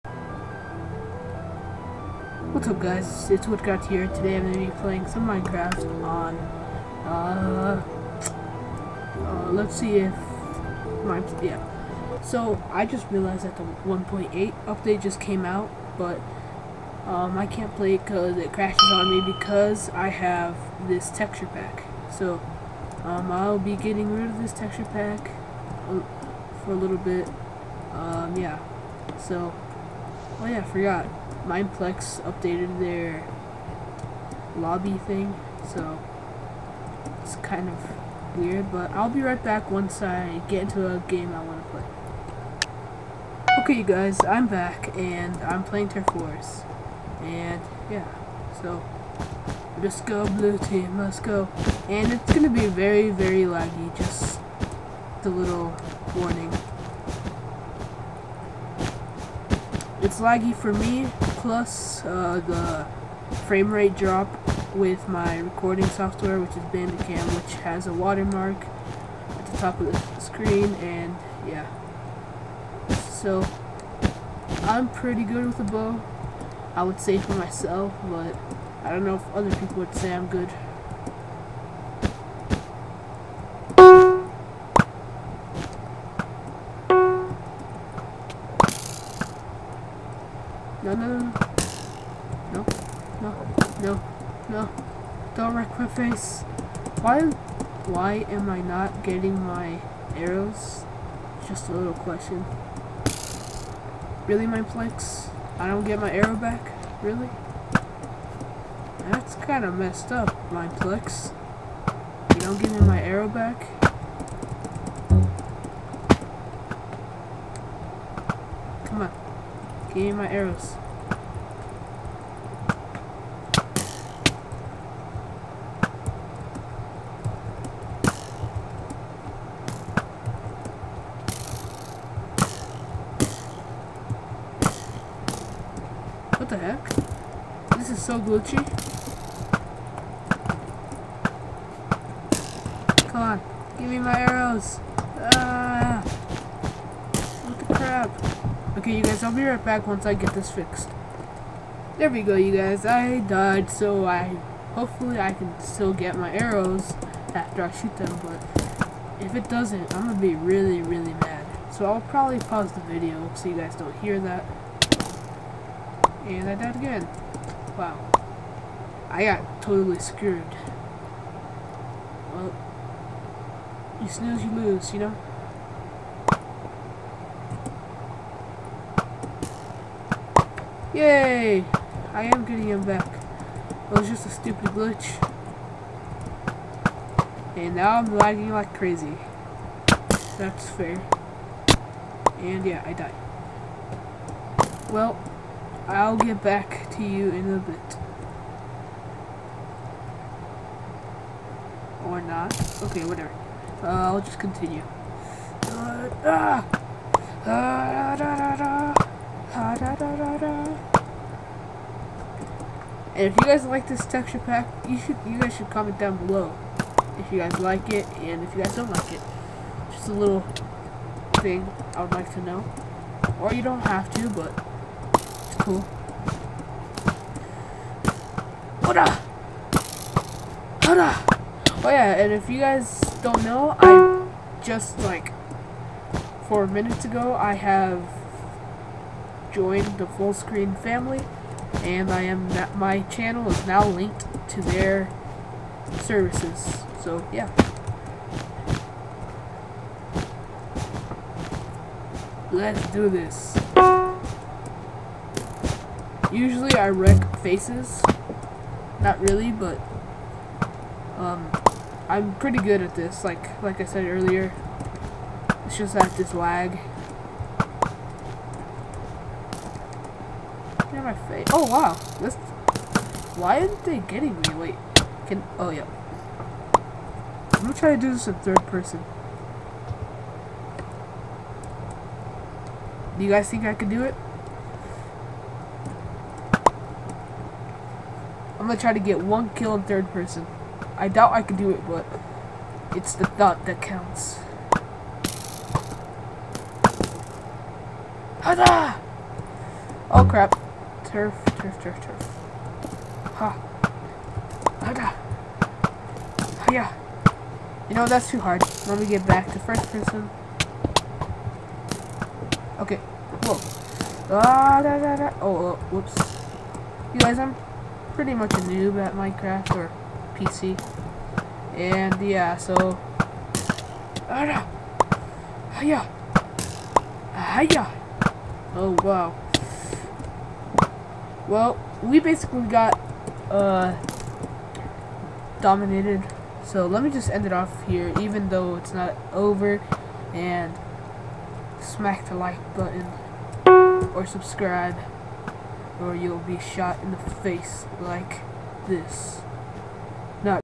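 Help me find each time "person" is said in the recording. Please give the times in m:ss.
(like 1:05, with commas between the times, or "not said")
4:38, 4:50, 5:09.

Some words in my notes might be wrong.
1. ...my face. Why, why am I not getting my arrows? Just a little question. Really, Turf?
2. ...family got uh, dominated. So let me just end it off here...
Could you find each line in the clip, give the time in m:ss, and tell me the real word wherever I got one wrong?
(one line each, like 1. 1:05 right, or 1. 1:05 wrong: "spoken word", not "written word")
1. 1:35 wrong: "Mineplex", not "Turf"
2. 5:32 wrong: "basically", not "family".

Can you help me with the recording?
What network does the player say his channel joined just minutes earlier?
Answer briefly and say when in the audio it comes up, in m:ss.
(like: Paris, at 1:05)
Full screen family, at 4:00.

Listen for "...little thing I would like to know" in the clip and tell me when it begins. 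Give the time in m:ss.
3:40.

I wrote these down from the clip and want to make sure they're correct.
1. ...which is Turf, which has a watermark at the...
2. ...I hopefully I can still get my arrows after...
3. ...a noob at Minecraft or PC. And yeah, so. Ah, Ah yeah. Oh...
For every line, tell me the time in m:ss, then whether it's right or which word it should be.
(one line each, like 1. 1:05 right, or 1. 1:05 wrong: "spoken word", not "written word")
1. 1:06 wrong: "Bandicam", not "Turf"
2. 2:34 right
3. 5:18 right.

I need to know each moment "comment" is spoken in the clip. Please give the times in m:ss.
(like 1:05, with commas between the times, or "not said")
3:35.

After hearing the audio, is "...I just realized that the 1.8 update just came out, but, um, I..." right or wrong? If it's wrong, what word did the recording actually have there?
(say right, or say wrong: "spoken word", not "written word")
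right.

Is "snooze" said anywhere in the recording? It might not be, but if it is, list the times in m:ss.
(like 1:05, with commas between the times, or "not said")
2:54.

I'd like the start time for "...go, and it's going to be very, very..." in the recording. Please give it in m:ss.
0:51.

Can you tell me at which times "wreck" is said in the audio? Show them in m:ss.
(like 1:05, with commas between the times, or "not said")
1:35, 4:16.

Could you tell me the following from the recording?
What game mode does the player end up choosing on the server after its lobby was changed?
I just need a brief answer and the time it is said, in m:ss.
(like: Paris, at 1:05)
Turf Wars, at 0:45.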